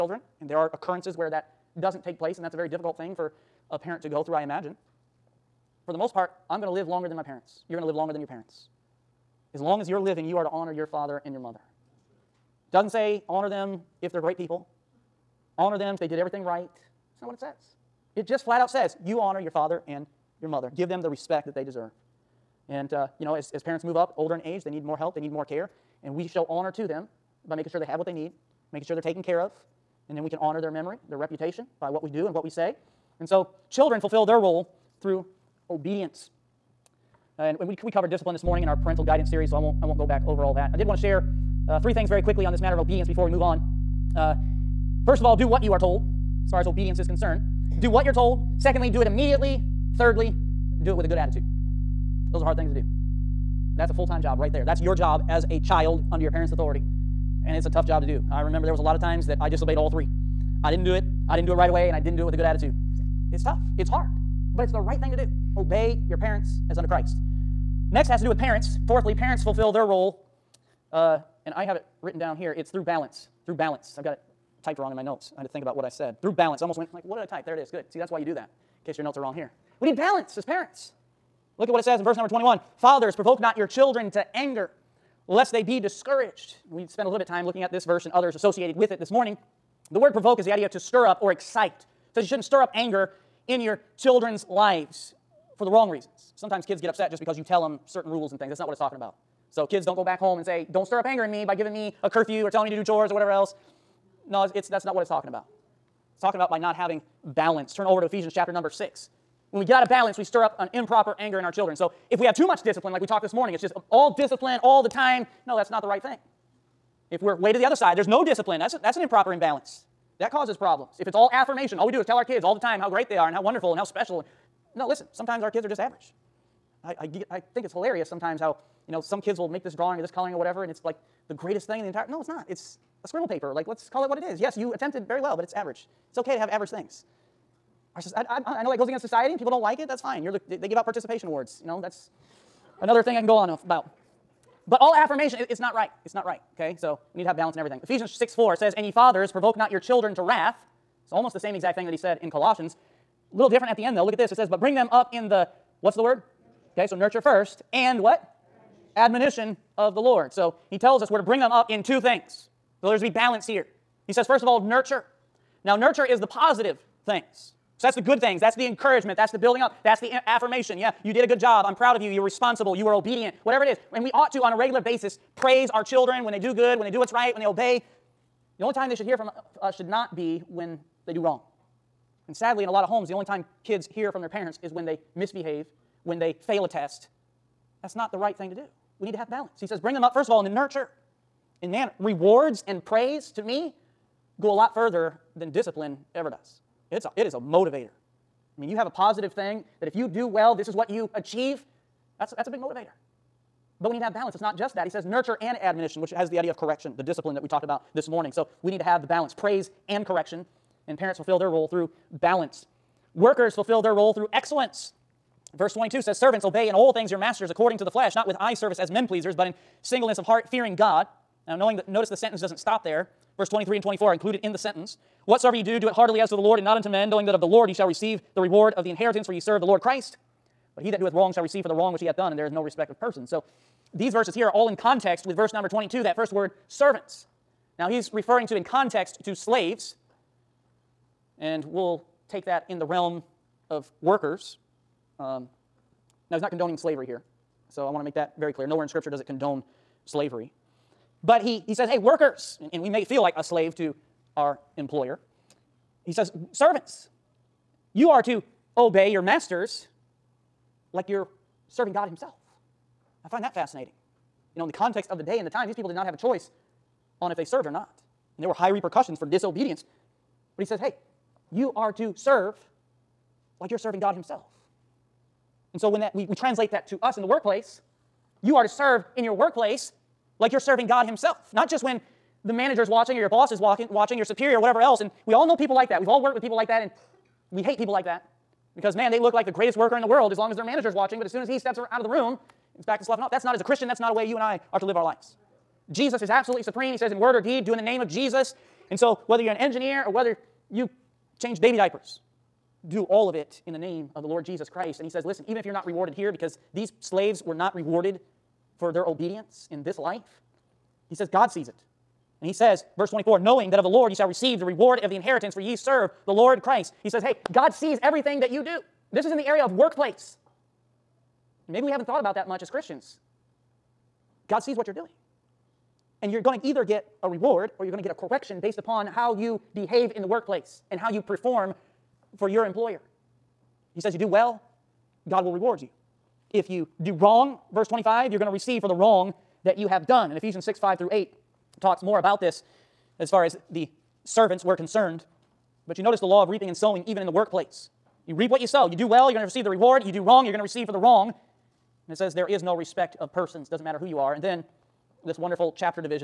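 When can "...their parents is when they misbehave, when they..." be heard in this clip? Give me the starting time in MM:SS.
03:04.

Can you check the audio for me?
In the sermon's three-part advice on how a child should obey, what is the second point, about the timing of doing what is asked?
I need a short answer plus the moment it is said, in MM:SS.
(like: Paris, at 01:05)
Do it immediately, at 00:48.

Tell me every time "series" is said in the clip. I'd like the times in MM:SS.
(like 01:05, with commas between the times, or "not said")
00:39.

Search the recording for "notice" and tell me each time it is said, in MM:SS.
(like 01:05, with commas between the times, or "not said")
03:41, 05:46.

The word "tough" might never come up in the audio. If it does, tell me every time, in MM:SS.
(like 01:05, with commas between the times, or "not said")
00:57, 01:03.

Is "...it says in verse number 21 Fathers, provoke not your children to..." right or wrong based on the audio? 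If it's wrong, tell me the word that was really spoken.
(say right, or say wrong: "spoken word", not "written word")
right.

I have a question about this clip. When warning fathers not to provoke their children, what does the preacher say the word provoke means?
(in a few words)
Stir up or excite.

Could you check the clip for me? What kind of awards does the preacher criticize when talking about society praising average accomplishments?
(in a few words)
Participation awards.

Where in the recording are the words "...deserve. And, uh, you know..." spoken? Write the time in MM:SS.
00:21.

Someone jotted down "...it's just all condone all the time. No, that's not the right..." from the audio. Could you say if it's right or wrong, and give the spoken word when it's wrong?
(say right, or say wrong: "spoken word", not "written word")
wrong: "discipline", not "condone".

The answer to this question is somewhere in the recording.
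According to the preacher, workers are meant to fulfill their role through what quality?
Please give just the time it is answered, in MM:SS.
03:34.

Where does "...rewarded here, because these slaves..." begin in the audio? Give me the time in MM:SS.
05:05.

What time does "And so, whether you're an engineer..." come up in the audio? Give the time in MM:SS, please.
04:58.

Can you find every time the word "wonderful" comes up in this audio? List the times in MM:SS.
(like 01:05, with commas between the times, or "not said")
02:03, 05:55.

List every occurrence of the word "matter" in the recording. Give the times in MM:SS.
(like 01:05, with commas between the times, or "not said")
00:42, 05:53.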